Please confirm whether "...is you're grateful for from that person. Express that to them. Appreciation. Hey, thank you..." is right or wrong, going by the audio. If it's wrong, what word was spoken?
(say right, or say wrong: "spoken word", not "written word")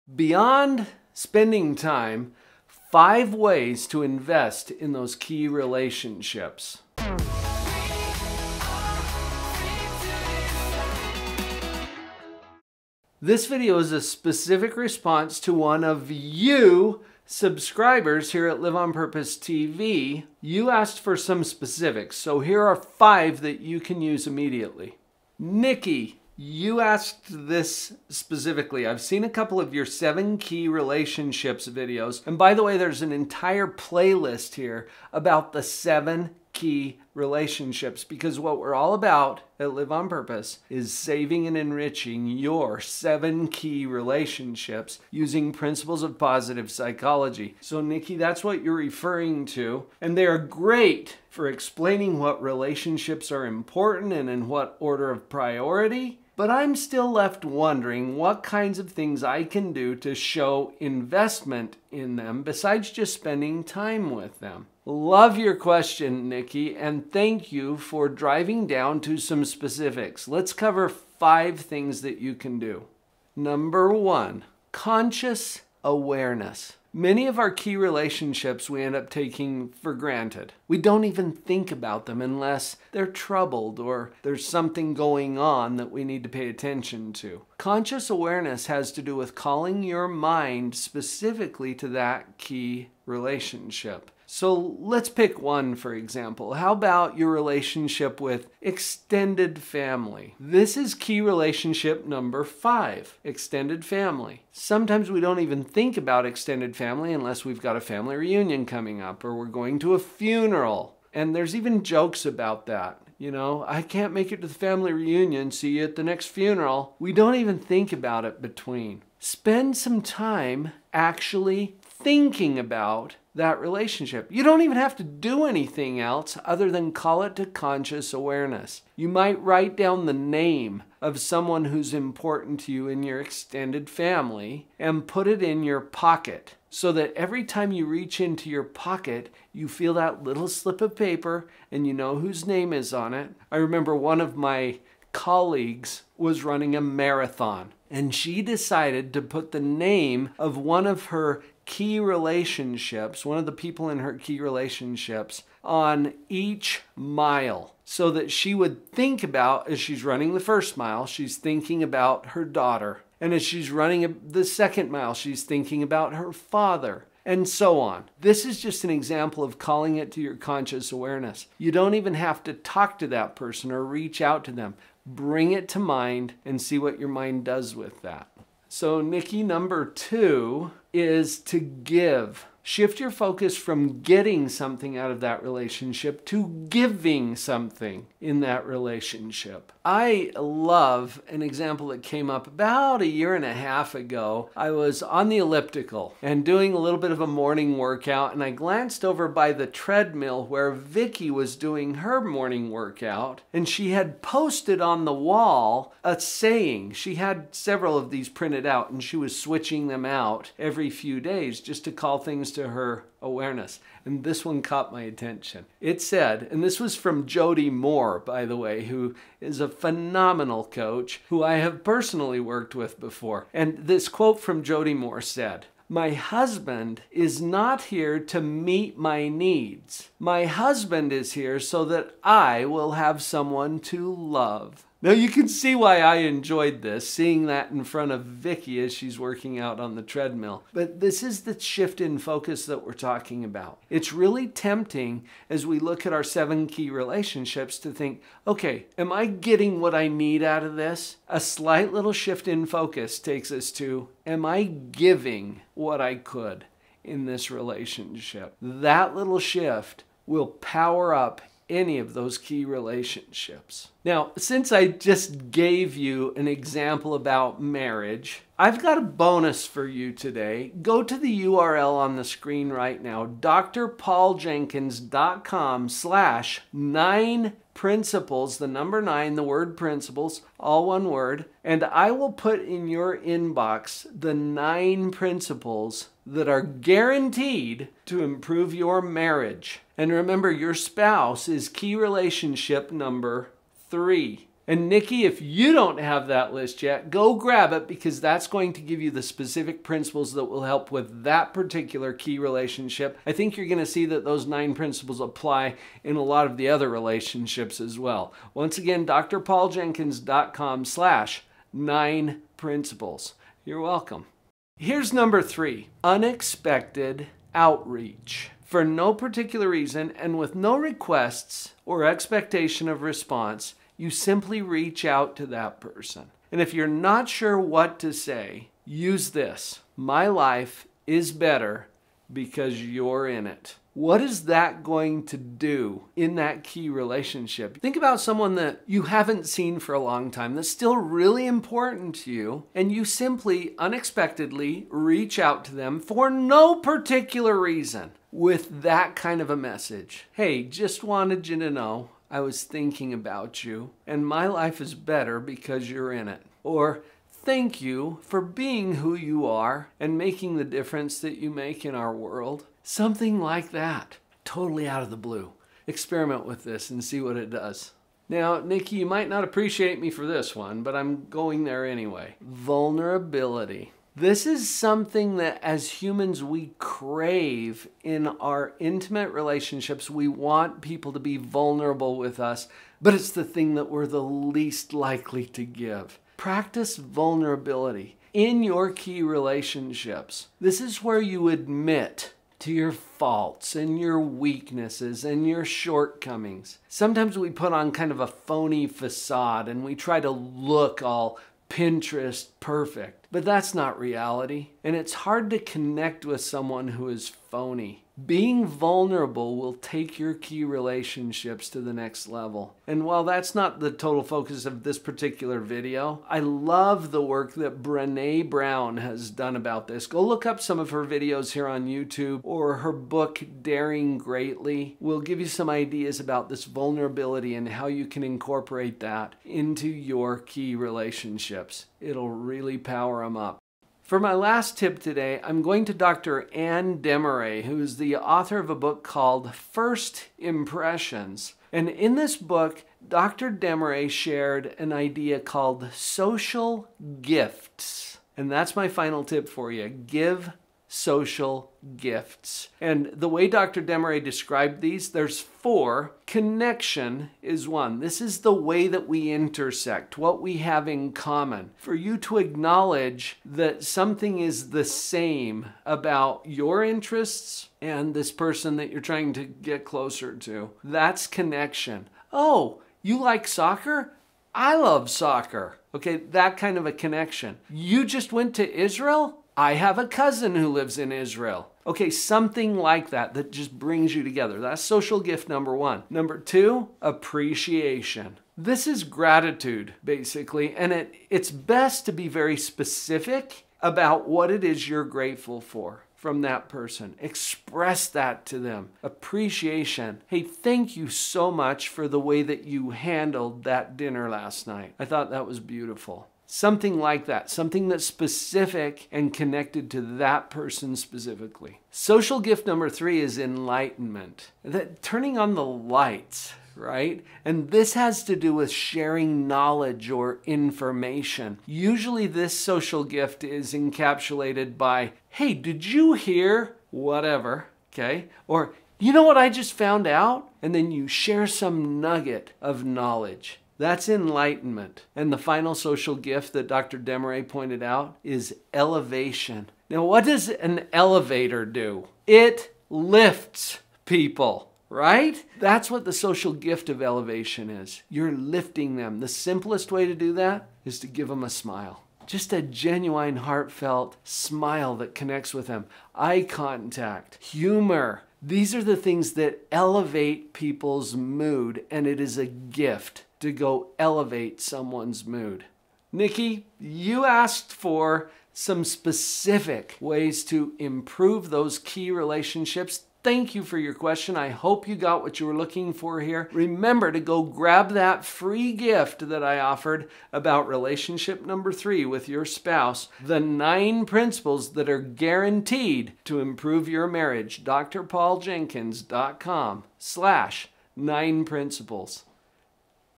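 right.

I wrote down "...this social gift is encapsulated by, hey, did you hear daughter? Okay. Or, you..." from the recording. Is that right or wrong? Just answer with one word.
wrong.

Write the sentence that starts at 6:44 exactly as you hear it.
And it's hard to connect with someone who is phony.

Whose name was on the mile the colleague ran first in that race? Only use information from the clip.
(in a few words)
Her daughter.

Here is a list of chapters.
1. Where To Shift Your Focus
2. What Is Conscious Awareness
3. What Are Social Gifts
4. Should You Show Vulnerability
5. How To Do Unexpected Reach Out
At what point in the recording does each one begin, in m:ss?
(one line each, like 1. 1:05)
1. 2:58
2. 1:13
3. 7:13
4. 6:07
5. 5:14.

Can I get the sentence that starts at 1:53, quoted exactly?
You know, I can't make it to the family reunion, see you at the next funeral.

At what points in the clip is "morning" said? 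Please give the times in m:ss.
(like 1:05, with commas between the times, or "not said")
3:17, 3:22.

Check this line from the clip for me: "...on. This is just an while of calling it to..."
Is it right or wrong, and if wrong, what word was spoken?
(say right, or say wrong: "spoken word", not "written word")
wrong: "example", not "while".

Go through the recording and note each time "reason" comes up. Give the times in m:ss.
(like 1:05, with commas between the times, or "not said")
5:19, 5:47.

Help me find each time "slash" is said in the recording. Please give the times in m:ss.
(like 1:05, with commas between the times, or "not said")
4:35, 5:10, 9:49.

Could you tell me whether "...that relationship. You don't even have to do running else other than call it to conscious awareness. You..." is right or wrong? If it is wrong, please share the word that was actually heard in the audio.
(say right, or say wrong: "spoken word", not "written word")
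wrong: "anything", not "running".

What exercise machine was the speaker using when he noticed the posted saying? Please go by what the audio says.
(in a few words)
Elliptical.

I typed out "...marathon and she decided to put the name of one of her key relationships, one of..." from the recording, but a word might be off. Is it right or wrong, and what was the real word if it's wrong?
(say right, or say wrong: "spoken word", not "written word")
right.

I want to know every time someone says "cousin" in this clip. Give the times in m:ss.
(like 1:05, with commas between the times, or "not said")
8:00.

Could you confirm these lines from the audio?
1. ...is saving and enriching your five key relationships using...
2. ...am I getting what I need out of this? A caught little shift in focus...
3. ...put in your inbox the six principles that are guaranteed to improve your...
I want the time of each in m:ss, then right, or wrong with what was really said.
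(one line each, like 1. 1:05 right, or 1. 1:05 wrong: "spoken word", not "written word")
1. 0:40 wrong: "seven", not "five"
2. 4:08 wrong: "slight", not "caught"
3. 4:42 wrong: "nine", not "six".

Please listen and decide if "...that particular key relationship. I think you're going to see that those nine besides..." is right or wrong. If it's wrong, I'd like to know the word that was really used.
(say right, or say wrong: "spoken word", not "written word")
wrong: "principles", not "besides".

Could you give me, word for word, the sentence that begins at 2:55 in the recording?
Bring it to mind and see what your mind does with that.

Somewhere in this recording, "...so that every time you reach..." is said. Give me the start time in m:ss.
2:16.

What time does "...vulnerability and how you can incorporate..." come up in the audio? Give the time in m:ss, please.
7:06.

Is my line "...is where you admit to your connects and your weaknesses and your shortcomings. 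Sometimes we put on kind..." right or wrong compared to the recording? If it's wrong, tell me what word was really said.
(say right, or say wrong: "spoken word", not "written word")
wrong: "faults", not "connects".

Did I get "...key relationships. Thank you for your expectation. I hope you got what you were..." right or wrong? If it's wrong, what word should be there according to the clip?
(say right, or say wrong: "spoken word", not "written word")
wrong: "question", not "expectation".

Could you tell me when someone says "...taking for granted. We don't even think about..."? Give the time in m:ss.
1:19.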